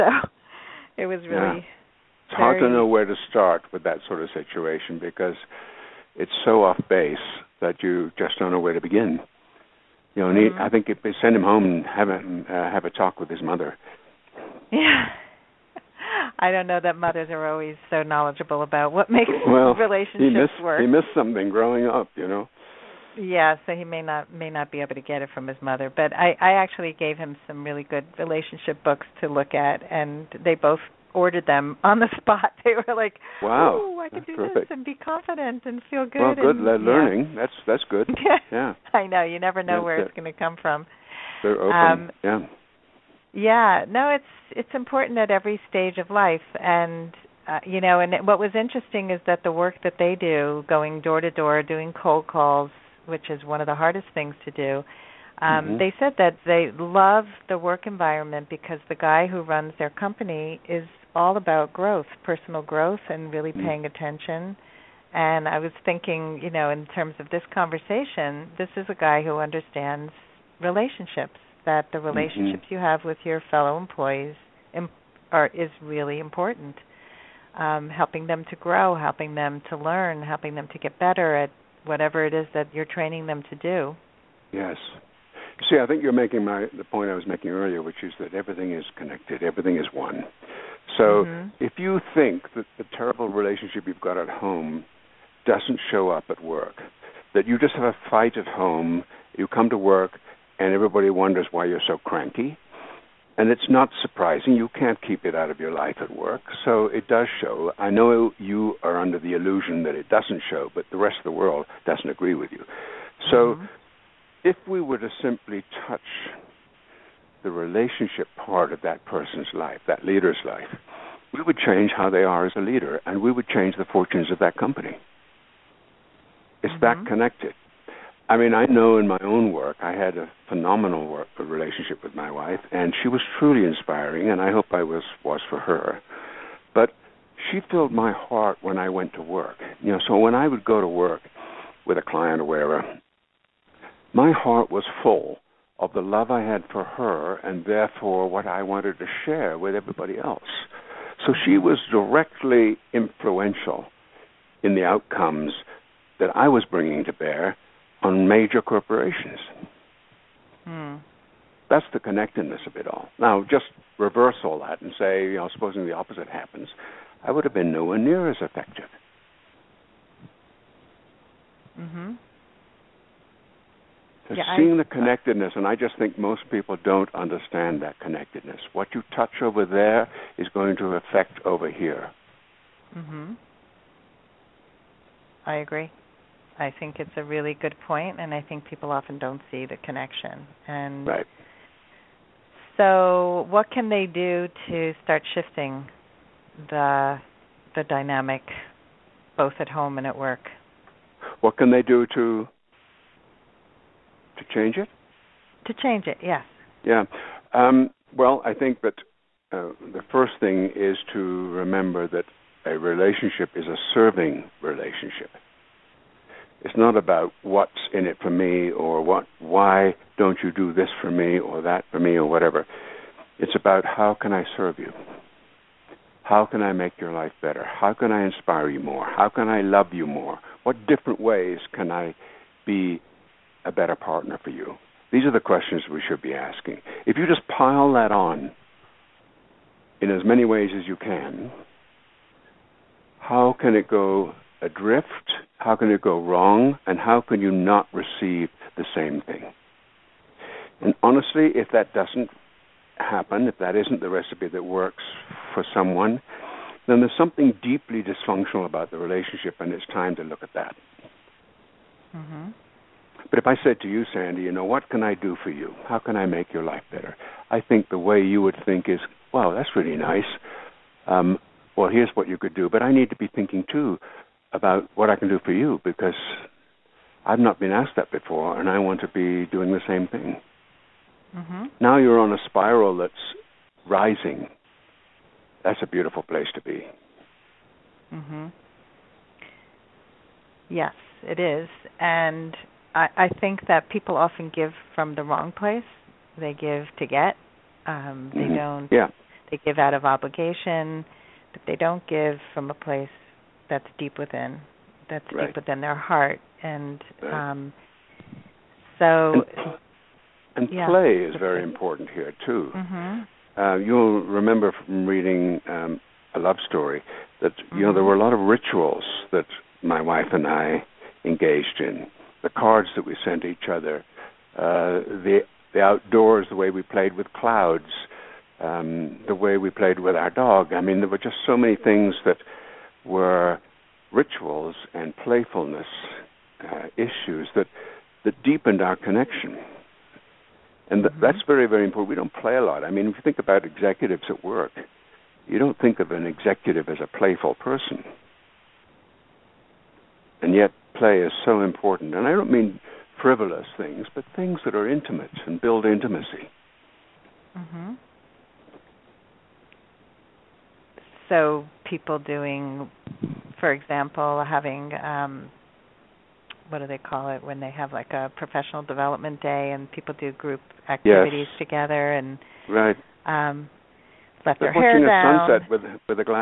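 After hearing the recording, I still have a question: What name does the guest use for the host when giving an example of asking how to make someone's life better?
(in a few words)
Sandy.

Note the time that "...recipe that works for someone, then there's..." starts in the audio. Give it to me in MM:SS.
04:14.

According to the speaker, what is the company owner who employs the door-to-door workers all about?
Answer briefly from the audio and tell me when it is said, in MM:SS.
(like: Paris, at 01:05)
personal growth, at 01:02.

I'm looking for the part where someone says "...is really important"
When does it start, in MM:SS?
01:15.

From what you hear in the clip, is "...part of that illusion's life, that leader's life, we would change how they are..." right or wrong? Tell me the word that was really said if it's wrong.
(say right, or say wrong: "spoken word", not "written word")
wrong: "person", not "illusion".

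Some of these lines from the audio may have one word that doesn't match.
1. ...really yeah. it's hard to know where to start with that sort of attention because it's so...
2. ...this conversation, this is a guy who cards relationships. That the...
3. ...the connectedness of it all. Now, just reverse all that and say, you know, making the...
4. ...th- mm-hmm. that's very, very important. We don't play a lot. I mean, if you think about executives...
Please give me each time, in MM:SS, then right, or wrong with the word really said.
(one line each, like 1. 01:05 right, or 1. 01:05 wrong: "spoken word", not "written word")
1. 00:01 wrong: "situation", not "attention"
2. 01:07 wrong: "understands", not "cards"
3. 02:41 wrong: "supposing", not "making"
4. 05:41 right.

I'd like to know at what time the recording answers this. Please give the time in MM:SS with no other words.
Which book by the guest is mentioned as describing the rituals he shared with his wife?
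05:16.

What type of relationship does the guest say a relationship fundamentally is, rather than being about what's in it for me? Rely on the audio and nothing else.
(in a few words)
a serving relationship.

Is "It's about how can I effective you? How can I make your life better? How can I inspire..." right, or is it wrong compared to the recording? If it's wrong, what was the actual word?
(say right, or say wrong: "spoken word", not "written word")
wrong: "serve", not "effective".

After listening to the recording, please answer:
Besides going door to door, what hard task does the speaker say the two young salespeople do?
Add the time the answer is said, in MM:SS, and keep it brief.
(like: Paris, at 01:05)
cold calls, at 00:52.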